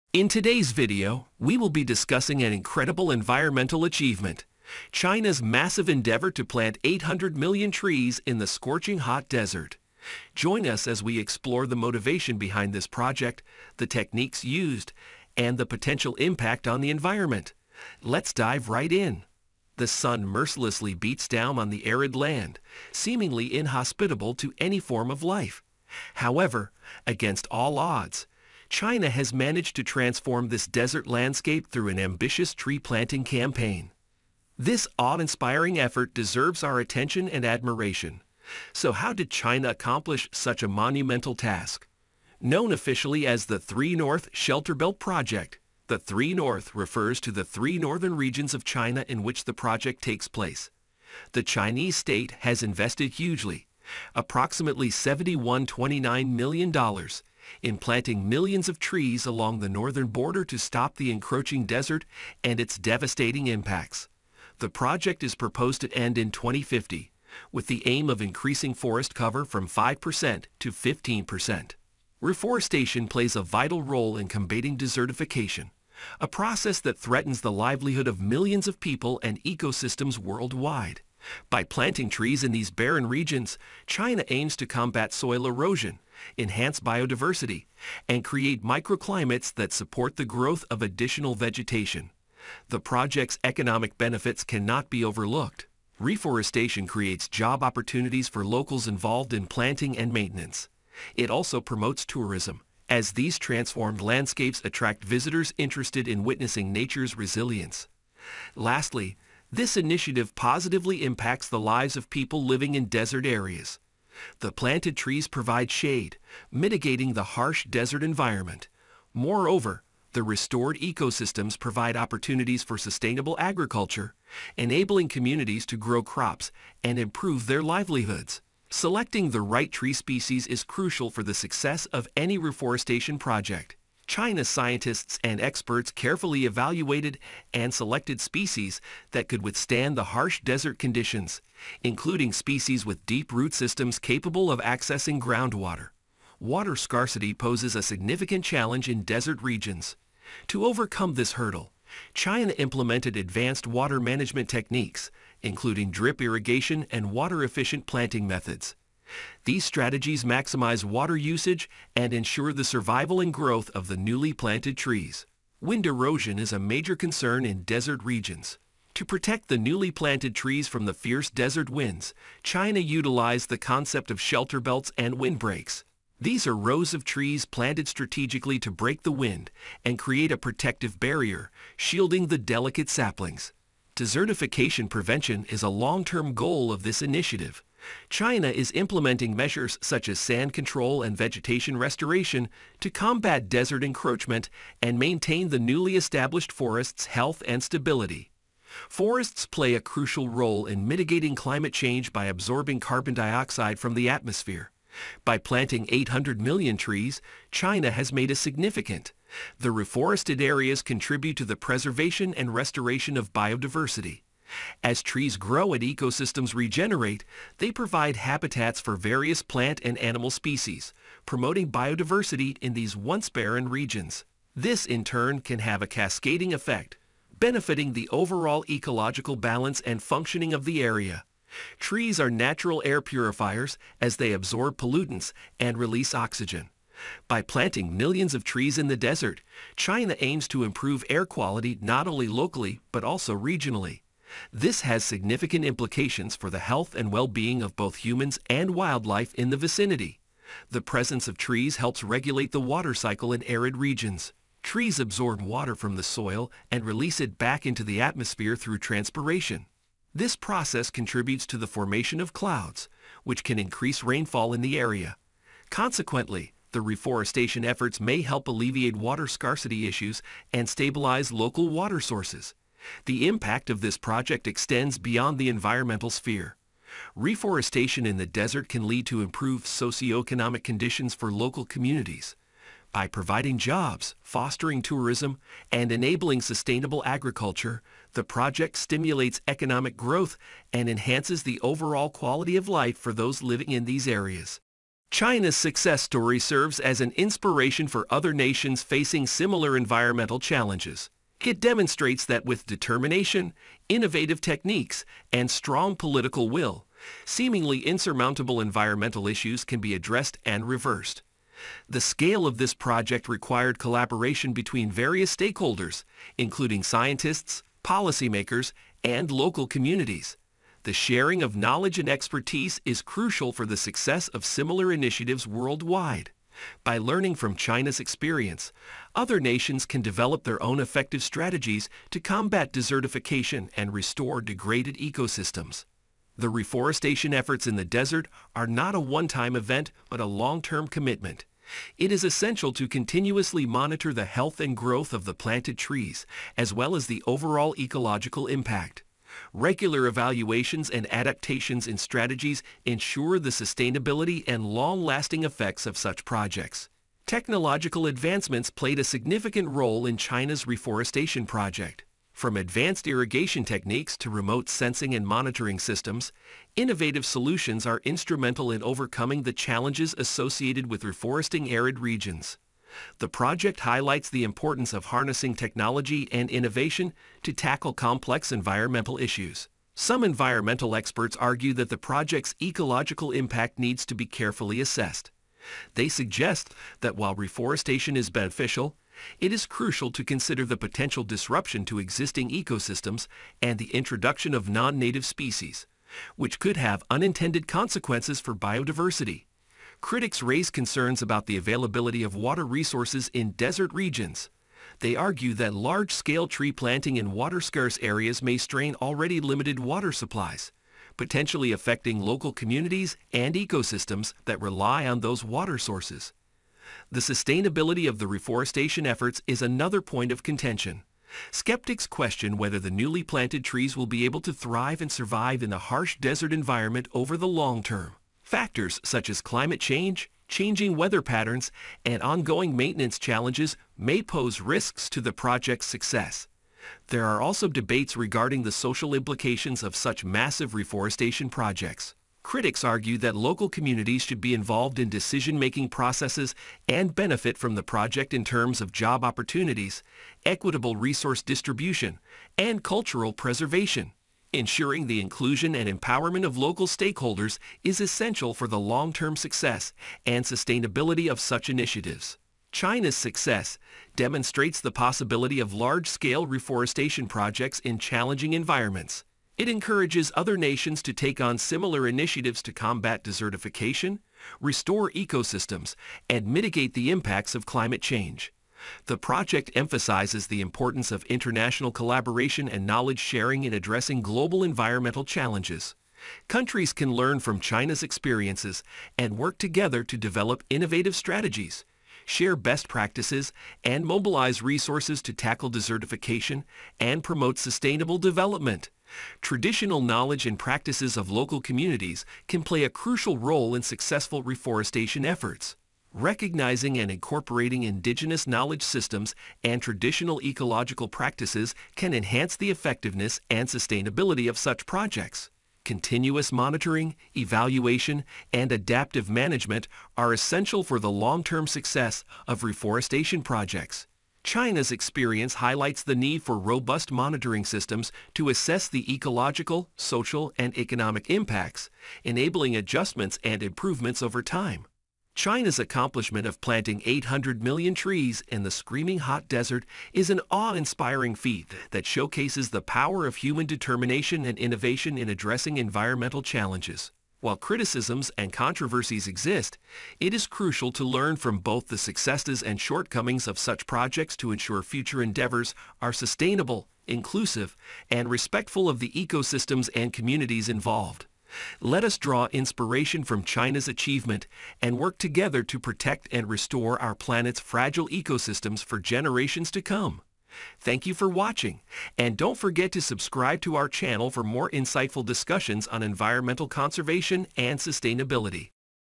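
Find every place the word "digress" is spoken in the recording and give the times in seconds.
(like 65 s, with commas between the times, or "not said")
not said.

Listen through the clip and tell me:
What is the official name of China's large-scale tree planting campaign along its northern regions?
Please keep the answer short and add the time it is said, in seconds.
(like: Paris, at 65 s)
Three North Shelter Belt Project, at 43 s.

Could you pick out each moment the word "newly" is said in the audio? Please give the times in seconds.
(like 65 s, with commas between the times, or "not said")
163 s, 169 s, 195 s, 422 s.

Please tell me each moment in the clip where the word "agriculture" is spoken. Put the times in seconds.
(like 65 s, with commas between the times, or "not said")
123 s, 287 s.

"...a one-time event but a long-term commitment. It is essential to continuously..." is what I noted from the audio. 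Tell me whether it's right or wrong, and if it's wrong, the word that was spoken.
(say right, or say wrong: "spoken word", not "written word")
right.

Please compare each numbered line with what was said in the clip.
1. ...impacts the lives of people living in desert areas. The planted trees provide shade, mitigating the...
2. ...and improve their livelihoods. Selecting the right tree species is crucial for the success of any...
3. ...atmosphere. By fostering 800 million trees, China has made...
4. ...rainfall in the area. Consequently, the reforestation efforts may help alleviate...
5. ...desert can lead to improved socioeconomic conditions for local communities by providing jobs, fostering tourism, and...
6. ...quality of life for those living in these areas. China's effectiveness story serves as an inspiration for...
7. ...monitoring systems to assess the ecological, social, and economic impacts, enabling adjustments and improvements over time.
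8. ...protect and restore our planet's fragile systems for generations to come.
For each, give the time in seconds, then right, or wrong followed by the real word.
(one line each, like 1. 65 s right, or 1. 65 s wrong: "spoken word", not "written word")
1. 111 s right
2. 126 s right
3. 204 s wrong: "planting", not "fostering"
4. 264 s right
5. 278 s right
6. 292 s wrong: "success", not "effectiveness"
7. 527 s right
8. 565 s wrong: "ecosystems", not "systems".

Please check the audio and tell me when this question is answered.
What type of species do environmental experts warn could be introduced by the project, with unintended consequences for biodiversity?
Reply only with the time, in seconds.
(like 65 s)
394 s.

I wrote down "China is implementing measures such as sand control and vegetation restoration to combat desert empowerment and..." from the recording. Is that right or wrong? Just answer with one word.
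wrong.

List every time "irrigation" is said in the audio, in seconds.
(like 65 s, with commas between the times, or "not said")
156 s, 363 s.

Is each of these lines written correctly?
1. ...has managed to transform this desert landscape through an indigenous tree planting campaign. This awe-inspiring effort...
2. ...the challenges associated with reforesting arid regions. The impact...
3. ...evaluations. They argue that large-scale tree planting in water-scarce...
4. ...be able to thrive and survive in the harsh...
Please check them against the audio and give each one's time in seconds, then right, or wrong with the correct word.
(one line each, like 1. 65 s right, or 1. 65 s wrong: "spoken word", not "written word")
1. 29 s wrong: "ambitious", not "indigenous"
2. 369 s wrong: "project", not "impact"
3. 403 s wrong: "regions", not "evaluations"
4. 424 s right.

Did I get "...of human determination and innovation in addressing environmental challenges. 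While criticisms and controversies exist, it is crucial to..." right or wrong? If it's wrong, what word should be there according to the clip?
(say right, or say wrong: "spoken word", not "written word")
right.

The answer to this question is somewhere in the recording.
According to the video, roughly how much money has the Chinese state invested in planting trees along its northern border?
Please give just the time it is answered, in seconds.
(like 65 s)
54 s.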